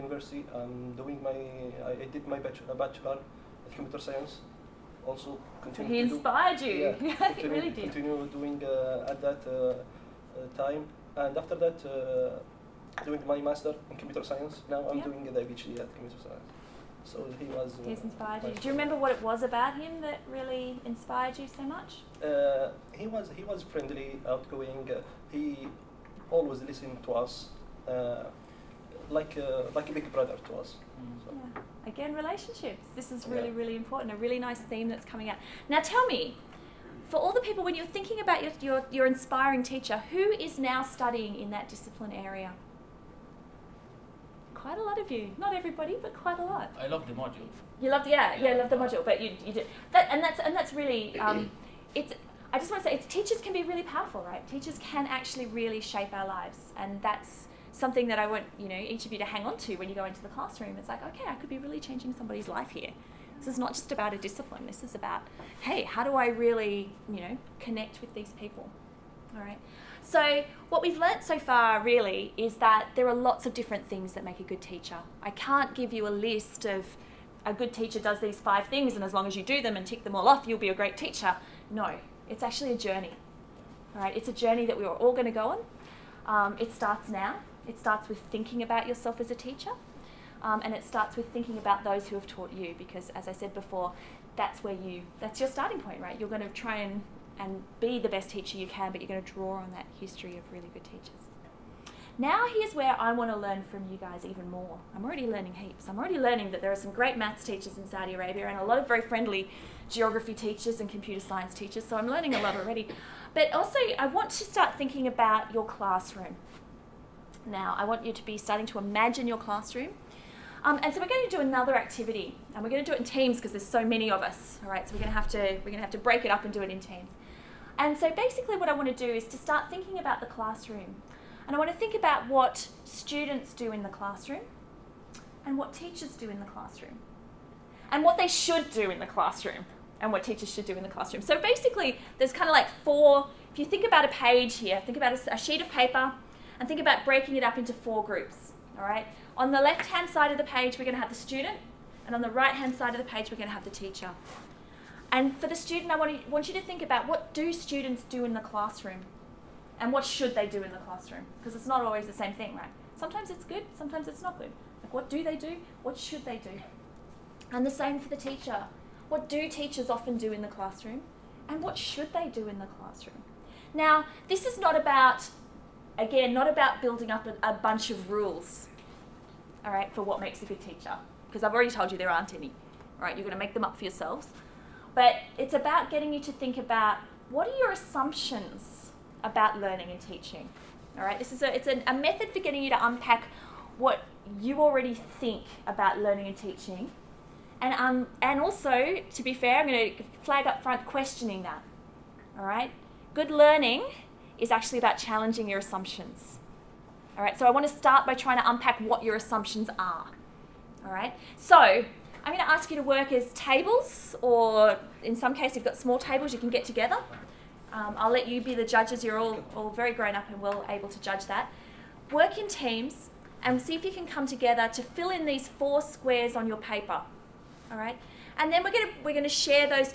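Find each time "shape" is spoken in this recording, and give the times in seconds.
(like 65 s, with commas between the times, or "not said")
55 s.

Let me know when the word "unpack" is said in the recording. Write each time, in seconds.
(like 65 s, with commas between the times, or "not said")
192 s, 208 s.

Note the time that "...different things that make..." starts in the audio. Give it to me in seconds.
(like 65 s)
73 s.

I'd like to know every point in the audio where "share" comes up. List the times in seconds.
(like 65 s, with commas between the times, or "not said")
229 s.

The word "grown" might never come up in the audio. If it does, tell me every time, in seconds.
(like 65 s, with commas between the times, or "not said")
219 s.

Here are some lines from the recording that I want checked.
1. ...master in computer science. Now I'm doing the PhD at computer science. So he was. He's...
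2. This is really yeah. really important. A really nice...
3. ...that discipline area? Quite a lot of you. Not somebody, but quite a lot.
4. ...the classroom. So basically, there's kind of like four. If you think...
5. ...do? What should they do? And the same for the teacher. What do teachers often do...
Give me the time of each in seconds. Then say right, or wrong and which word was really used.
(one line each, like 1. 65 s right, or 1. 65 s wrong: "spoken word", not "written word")
1. 13 s right
2. 32 s right
3. 41 s wrong: "everybody", not "somebody"
4. 140 s right
5. 165 s right.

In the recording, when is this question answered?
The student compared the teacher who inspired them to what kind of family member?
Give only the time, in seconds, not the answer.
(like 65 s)
29 s.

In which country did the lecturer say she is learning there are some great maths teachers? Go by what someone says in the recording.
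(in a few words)
Saudi Arabia.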